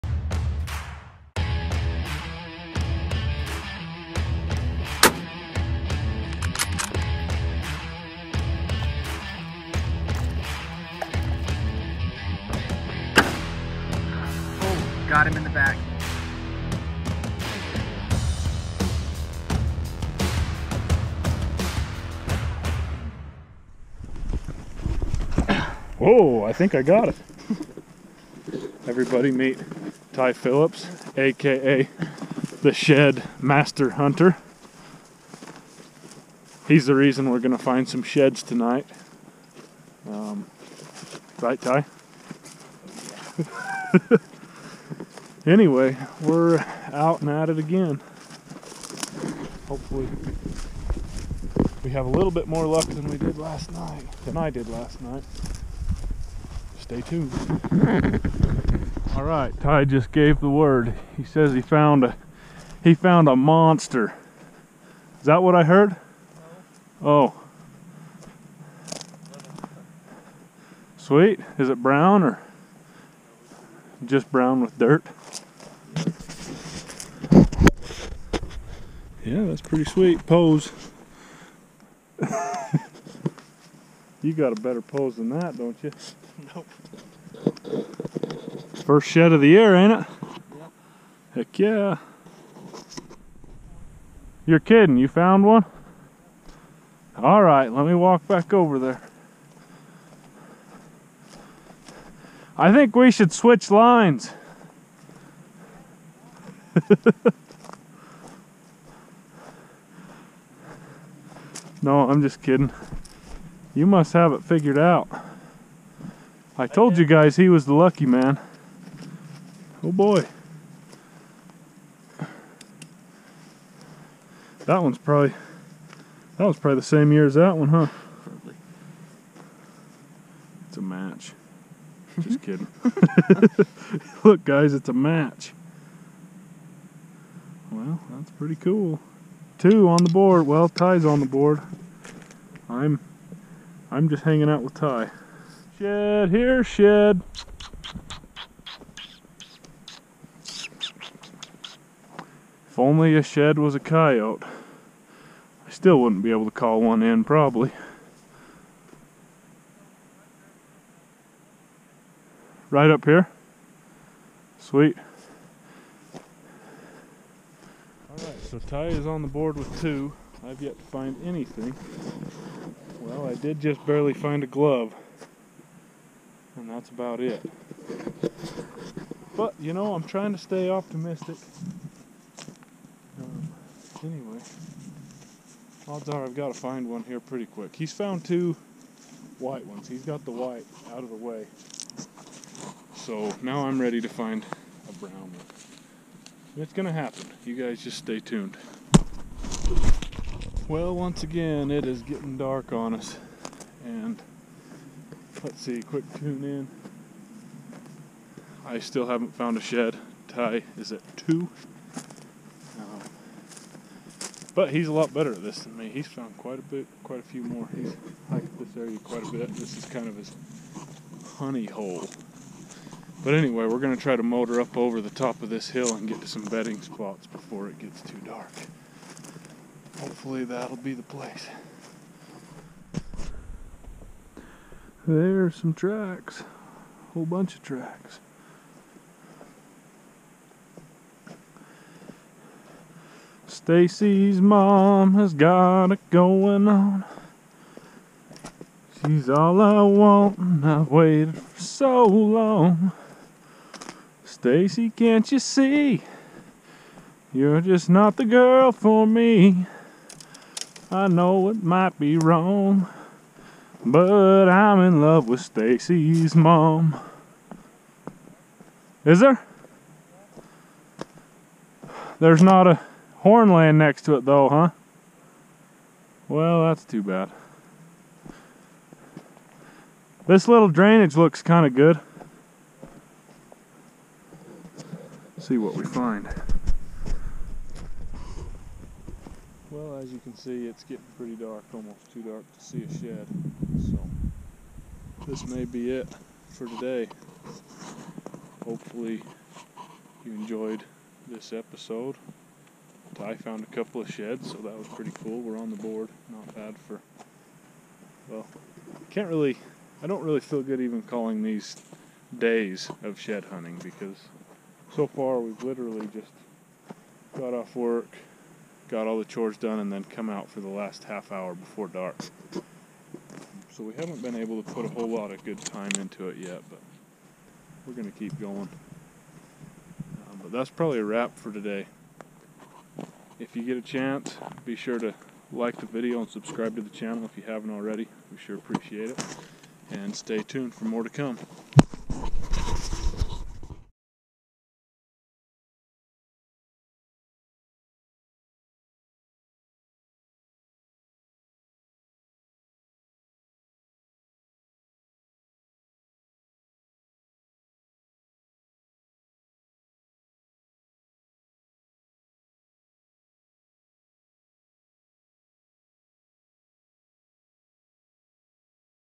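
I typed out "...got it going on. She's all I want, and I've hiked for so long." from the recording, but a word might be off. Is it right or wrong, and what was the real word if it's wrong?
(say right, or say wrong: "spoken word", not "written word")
wrong: "waited", not "hiked".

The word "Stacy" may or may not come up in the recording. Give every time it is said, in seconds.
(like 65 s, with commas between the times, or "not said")
243 s, 254 s, 265 s.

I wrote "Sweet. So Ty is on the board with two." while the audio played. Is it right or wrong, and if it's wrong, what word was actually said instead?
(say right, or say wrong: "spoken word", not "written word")
right.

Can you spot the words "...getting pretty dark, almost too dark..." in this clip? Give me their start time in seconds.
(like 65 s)
290 s.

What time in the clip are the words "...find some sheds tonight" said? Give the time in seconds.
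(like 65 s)
37 s.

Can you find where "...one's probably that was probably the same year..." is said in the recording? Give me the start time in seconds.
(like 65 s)
124 s.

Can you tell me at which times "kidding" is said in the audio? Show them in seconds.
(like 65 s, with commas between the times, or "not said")
94 s, 112 s, 132 s.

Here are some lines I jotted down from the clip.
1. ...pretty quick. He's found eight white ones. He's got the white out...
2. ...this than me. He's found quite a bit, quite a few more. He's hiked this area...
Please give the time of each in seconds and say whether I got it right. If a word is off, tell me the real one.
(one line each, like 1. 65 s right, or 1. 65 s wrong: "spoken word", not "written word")
1. 187 s wrong: "two", not "eight"
2. 215 s right.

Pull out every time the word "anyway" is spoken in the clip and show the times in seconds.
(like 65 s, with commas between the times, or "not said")
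45 s, 184 s, 223 s.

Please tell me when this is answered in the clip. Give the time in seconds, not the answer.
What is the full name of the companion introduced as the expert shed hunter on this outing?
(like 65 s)
30 s.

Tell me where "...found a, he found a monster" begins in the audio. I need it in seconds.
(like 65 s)
61 s.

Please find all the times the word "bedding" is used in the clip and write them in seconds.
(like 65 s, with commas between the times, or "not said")
226 s.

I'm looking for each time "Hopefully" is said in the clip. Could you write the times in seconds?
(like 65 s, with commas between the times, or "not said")
49 s, 229 s, 298 s.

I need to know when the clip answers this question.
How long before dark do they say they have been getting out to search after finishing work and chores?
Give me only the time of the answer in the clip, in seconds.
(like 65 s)
320 s.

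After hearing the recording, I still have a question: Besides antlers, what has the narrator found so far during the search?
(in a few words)
a glove.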